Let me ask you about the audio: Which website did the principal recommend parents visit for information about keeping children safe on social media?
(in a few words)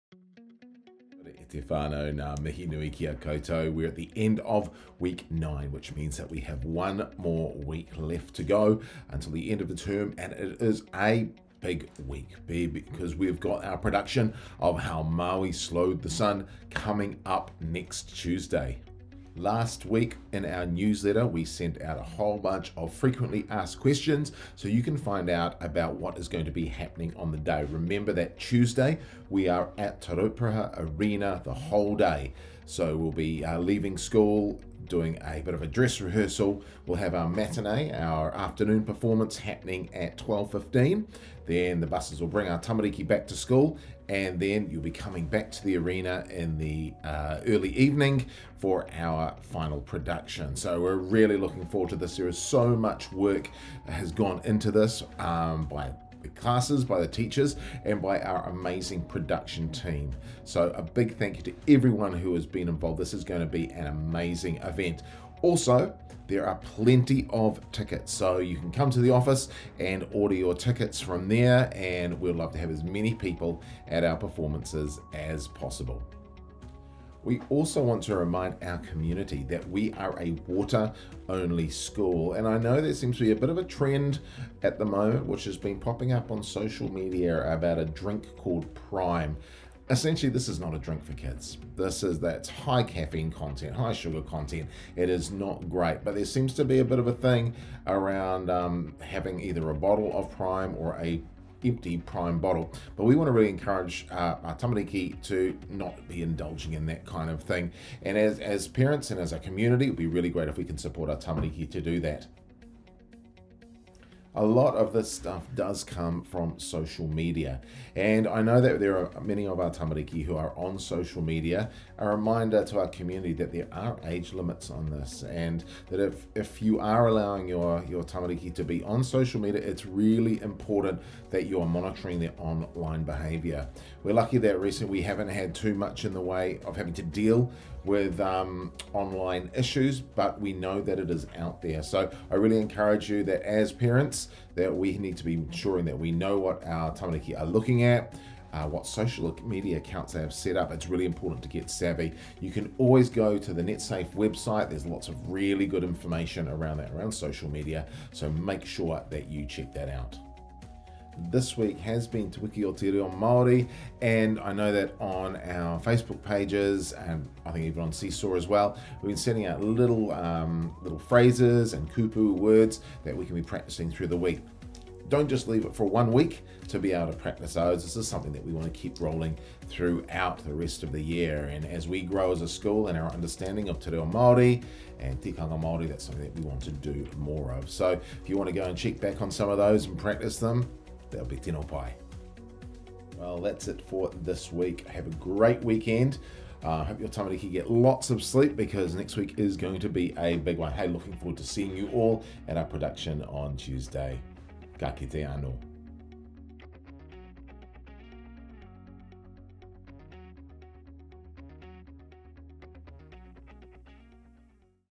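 NetSafe.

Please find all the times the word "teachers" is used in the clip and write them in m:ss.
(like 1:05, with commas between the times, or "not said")
0:57.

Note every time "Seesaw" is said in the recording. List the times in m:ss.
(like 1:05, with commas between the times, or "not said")
2:47.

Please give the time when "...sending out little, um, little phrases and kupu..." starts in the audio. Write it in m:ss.
2:49.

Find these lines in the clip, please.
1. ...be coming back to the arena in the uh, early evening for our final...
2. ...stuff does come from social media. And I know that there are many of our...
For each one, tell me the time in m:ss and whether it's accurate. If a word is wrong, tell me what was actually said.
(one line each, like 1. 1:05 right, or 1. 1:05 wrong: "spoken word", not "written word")
1. 0:44 right
2. 1:55 right.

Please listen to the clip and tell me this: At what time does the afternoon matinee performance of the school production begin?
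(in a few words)
12:15.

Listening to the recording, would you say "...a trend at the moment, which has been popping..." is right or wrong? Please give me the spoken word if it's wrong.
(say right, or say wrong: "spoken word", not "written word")
right.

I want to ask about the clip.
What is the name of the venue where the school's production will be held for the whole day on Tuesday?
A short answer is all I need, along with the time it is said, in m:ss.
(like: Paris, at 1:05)
Te Rauparaha Arena, at 0:30.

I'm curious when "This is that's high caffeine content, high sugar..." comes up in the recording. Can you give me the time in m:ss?
1:31.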